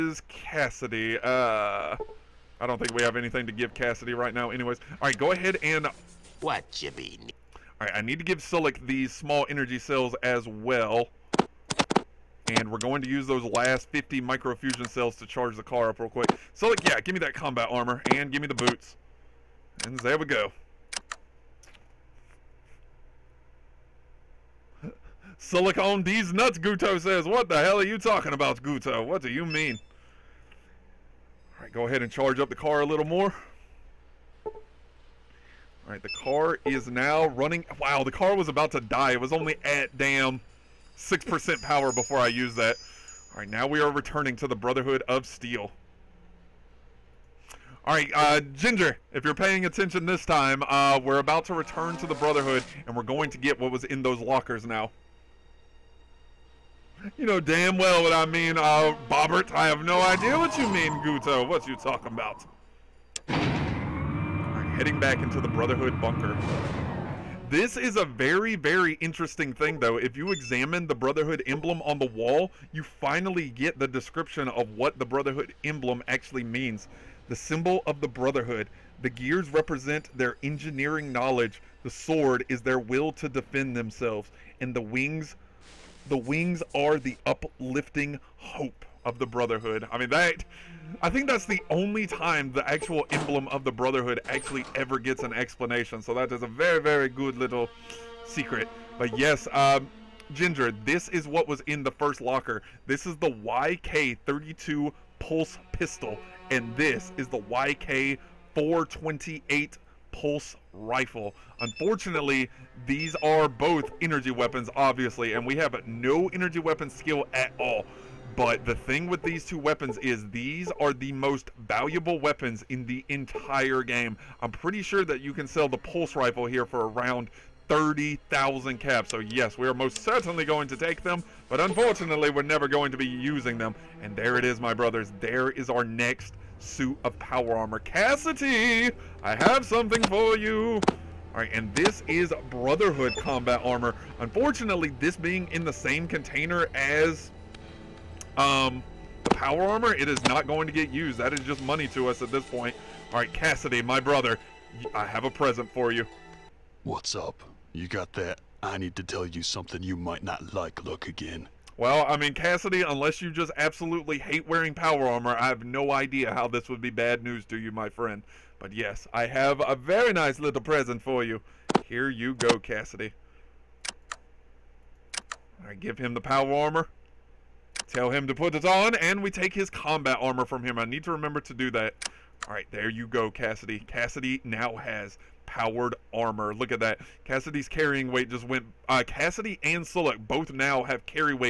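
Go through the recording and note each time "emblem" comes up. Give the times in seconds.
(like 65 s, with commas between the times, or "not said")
71 s, 75 s, 93 s.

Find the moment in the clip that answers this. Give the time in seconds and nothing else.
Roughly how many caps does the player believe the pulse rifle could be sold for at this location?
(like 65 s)
127 s.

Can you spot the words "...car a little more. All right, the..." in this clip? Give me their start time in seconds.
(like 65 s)
32 s.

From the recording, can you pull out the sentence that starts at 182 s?
All right, there you go, Cassidy.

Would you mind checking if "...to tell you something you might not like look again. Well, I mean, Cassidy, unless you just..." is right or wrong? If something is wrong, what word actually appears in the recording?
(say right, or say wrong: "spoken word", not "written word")
right.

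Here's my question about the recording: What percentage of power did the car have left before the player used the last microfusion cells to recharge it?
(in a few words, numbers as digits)
6%.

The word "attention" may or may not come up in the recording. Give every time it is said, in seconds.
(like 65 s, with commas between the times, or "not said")
49 s.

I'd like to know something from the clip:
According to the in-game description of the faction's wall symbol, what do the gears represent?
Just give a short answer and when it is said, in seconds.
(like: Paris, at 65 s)
Engineering knowledge, at 80 s.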